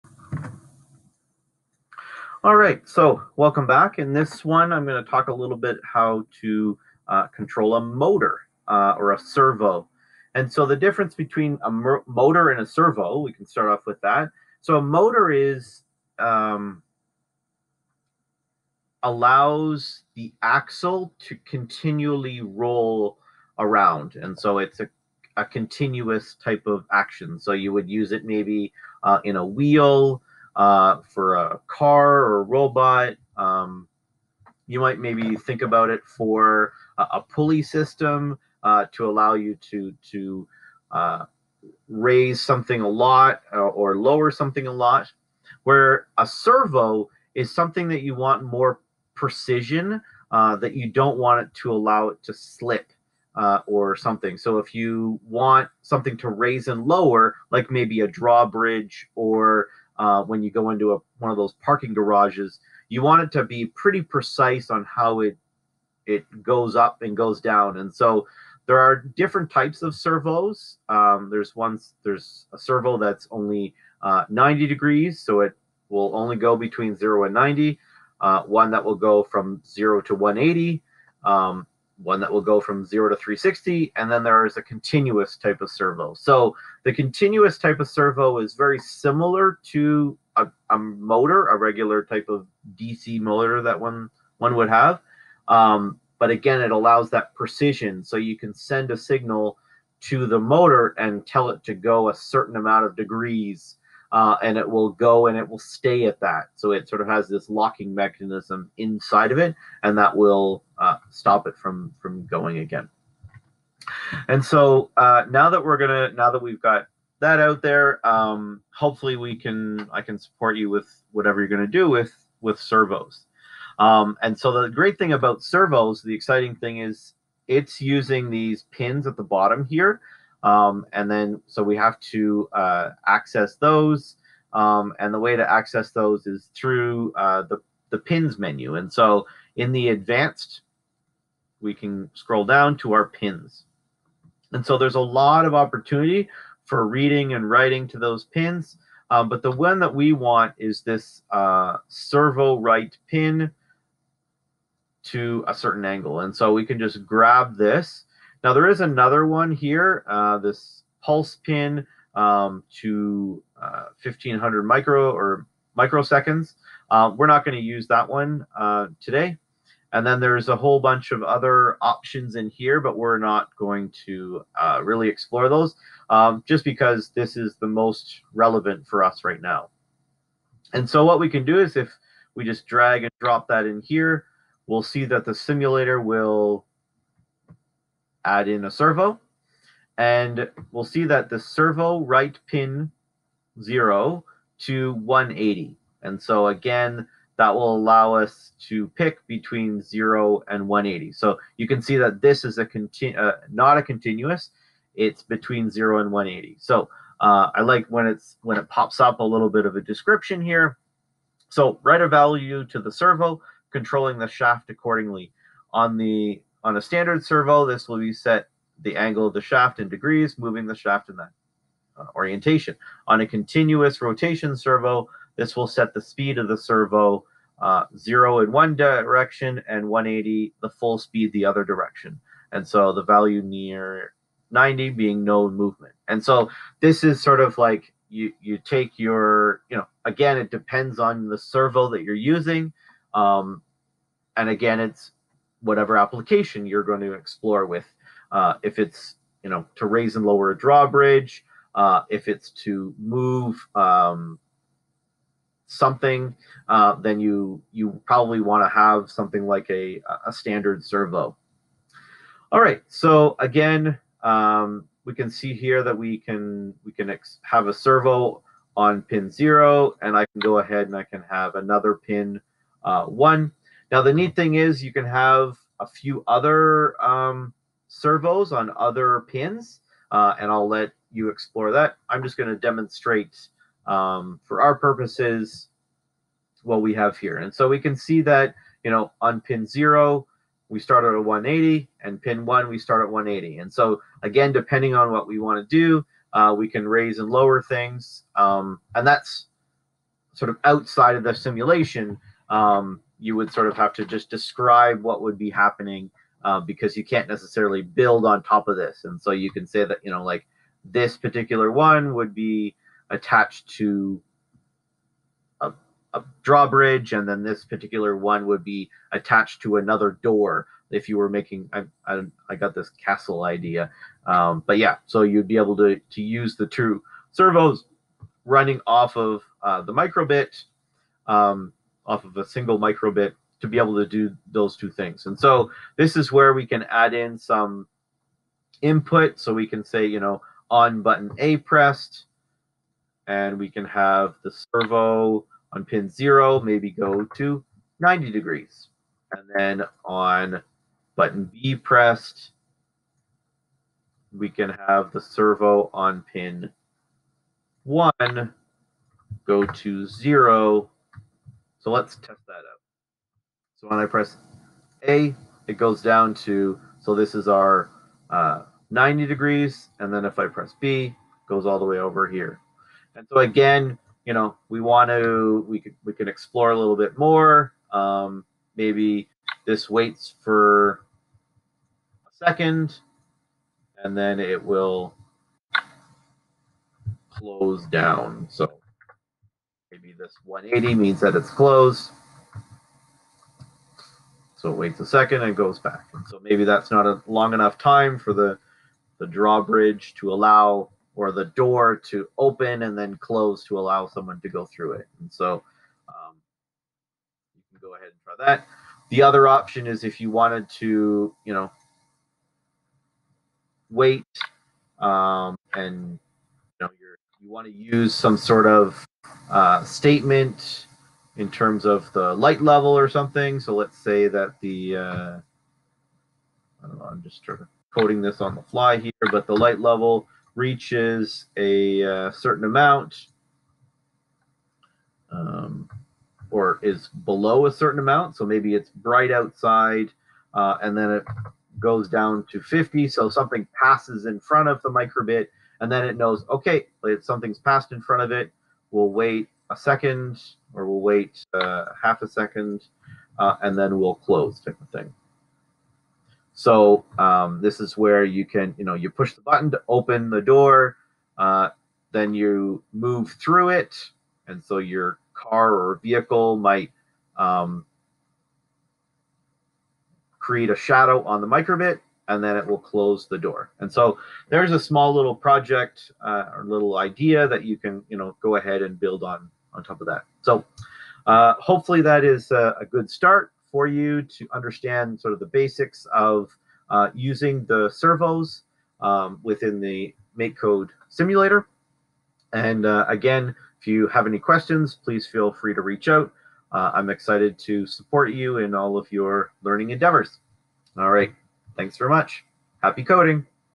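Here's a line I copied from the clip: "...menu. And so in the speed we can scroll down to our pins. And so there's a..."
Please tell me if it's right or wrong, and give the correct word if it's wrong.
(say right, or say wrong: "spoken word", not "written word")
wrong: "advanced", not "speed".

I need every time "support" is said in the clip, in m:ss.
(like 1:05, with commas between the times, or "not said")
2:00, 8:17.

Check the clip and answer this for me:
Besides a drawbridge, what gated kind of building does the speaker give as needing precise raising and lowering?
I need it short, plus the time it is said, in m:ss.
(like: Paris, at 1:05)
parking garages, at 1:01.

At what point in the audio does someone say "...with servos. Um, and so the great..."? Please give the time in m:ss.
2:02.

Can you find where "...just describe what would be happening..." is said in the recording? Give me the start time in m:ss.
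5:04.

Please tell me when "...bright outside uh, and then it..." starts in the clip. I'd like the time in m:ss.
7:18.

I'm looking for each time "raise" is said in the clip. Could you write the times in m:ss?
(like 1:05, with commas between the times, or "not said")
0:41, 0:56, 4:09, 4:56.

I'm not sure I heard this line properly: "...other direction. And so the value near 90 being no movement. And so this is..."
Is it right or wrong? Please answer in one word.
right.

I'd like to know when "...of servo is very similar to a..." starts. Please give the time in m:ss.
1:27.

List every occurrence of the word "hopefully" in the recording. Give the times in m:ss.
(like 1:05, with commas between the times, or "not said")
1:58, 8:01.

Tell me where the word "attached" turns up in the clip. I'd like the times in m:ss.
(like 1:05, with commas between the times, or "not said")
5:13, 5:19.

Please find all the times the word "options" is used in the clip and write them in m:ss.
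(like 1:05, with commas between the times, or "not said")
2:51, 6:49.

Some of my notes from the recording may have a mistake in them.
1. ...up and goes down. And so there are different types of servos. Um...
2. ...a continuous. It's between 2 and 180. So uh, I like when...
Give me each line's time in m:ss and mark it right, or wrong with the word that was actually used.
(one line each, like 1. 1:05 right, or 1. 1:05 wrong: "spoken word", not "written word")
1. 1:06 right
2. 3:23 wrong: "0", not "2".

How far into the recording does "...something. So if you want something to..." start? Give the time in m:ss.
0:53.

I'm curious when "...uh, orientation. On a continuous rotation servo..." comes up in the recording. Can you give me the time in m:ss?
3:41.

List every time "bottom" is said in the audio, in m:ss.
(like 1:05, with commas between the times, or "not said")
2:09.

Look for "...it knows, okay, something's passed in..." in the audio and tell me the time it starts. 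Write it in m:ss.
7:26.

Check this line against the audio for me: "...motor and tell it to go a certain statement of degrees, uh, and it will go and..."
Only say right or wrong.
wrong.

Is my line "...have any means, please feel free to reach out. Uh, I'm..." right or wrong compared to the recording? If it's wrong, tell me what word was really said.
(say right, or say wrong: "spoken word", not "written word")
wrong: "questions", not "means".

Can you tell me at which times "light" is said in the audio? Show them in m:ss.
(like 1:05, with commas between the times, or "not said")
7:02, 7:09.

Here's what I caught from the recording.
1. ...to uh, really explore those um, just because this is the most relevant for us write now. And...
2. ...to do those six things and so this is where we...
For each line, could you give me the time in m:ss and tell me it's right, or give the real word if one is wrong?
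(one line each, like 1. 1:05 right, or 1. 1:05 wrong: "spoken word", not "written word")
1. 2:54 right
2. 5:33 wrong: "two", not "six".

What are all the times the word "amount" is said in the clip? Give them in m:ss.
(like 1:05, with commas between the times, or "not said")
1:42, 7:12, 7:17.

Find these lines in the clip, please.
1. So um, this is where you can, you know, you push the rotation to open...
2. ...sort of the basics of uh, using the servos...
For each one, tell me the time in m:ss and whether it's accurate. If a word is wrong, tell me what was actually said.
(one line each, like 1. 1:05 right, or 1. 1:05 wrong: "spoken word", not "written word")
1. 7:36 wrong: "button", not "rotation"
2. 8:05 right.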